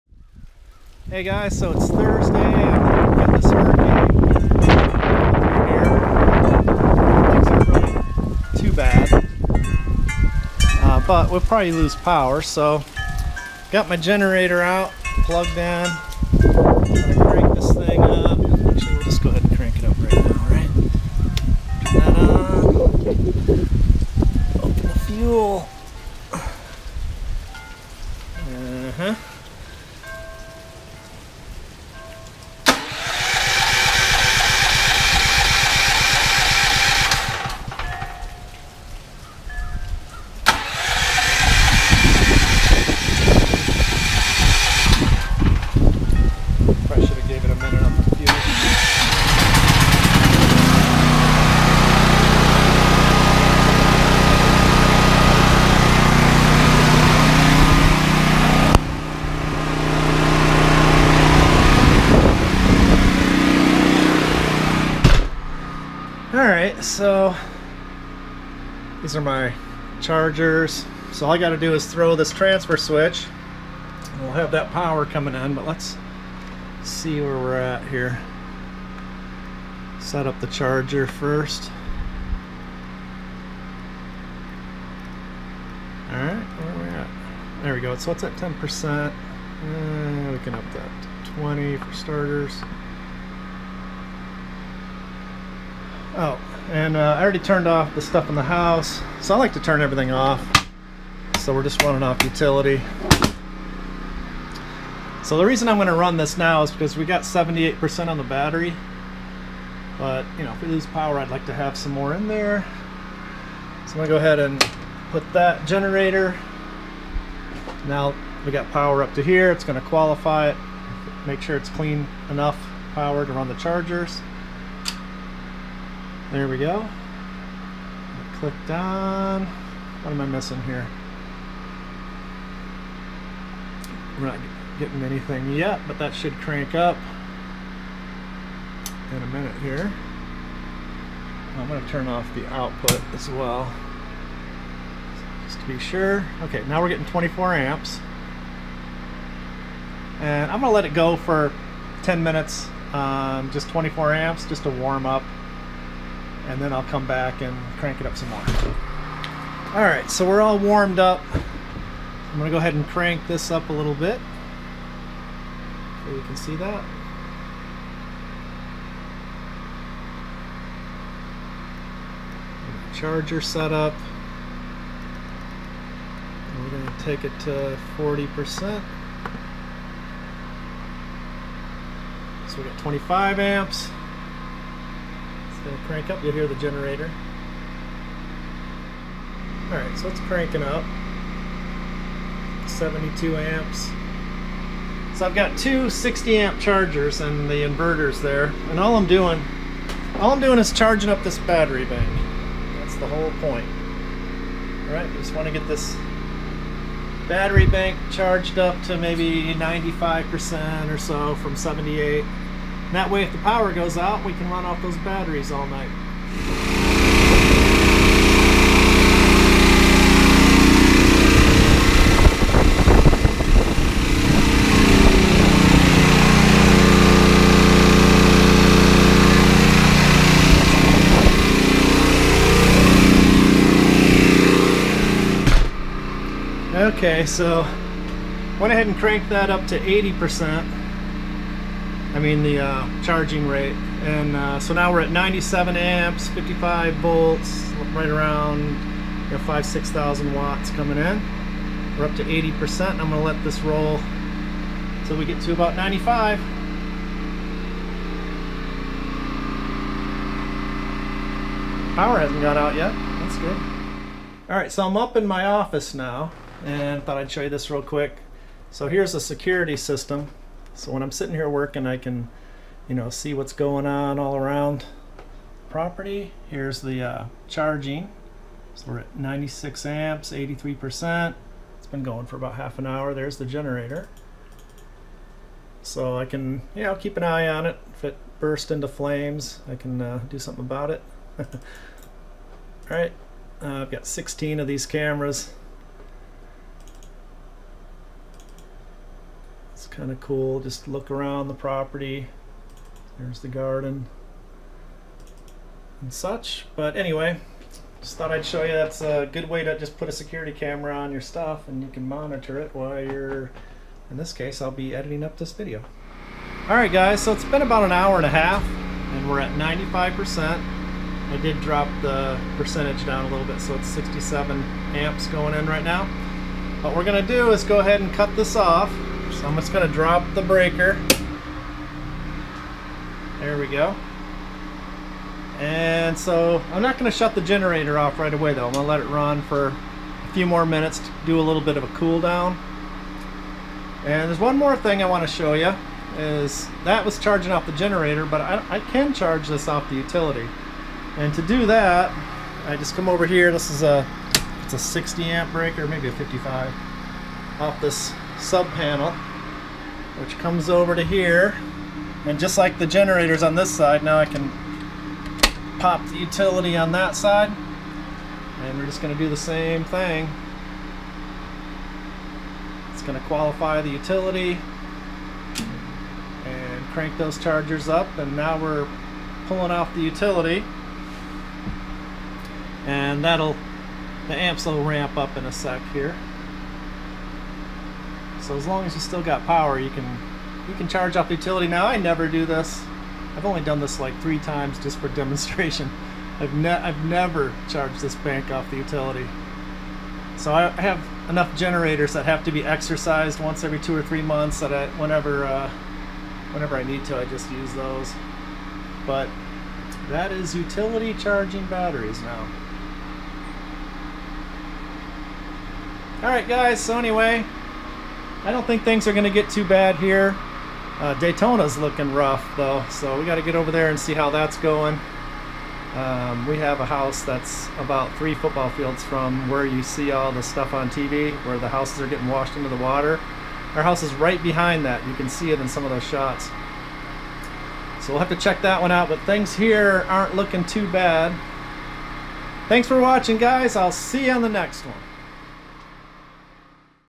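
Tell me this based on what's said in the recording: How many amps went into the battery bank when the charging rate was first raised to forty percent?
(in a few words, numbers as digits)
72 amps.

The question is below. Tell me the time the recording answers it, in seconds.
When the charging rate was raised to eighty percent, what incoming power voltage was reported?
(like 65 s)
246 s.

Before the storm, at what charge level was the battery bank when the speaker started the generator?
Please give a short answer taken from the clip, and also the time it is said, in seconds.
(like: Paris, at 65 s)
78%, at 107 s.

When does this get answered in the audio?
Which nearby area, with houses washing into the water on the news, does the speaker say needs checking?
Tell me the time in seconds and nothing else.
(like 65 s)
421 s.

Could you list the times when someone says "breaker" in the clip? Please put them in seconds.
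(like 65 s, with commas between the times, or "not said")
330 s, 355 s.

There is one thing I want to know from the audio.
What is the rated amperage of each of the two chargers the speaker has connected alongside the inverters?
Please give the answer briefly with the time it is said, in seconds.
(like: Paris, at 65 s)
60 amp, at 195 s.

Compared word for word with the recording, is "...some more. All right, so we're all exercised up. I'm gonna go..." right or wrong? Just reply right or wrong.
wrong.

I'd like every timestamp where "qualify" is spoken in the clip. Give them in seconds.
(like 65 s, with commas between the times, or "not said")
119 s, 373 s.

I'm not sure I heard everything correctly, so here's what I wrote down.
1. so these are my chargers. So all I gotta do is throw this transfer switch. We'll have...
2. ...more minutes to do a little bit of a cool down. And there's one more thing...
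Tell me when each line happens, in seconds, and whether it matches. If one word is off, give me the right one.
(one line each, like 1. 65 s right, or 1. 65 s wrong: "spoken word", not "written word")
1. 66 s right
2. 340 s right.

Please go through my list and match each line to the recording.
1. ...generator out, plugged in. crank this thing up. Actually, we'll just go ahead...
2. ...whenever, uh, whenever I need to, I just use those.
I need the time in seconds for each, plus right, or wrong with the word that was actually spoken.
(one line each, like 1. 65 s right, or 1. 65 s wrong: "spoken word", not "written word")
1. 13 s right
2. 404 s right.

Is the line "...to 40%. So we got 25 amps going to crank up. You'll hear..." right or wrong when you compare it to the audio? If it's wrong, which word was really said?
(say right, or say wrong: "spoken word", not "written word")
right.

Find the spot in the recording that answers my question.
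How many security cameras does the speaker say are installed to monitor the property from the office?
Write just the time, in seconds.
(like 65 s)
294 s.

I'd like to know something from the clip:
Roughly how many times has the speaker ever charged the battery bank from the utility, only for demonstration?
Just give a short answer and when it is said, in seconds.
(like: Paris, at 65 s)
3 times, at 394 s.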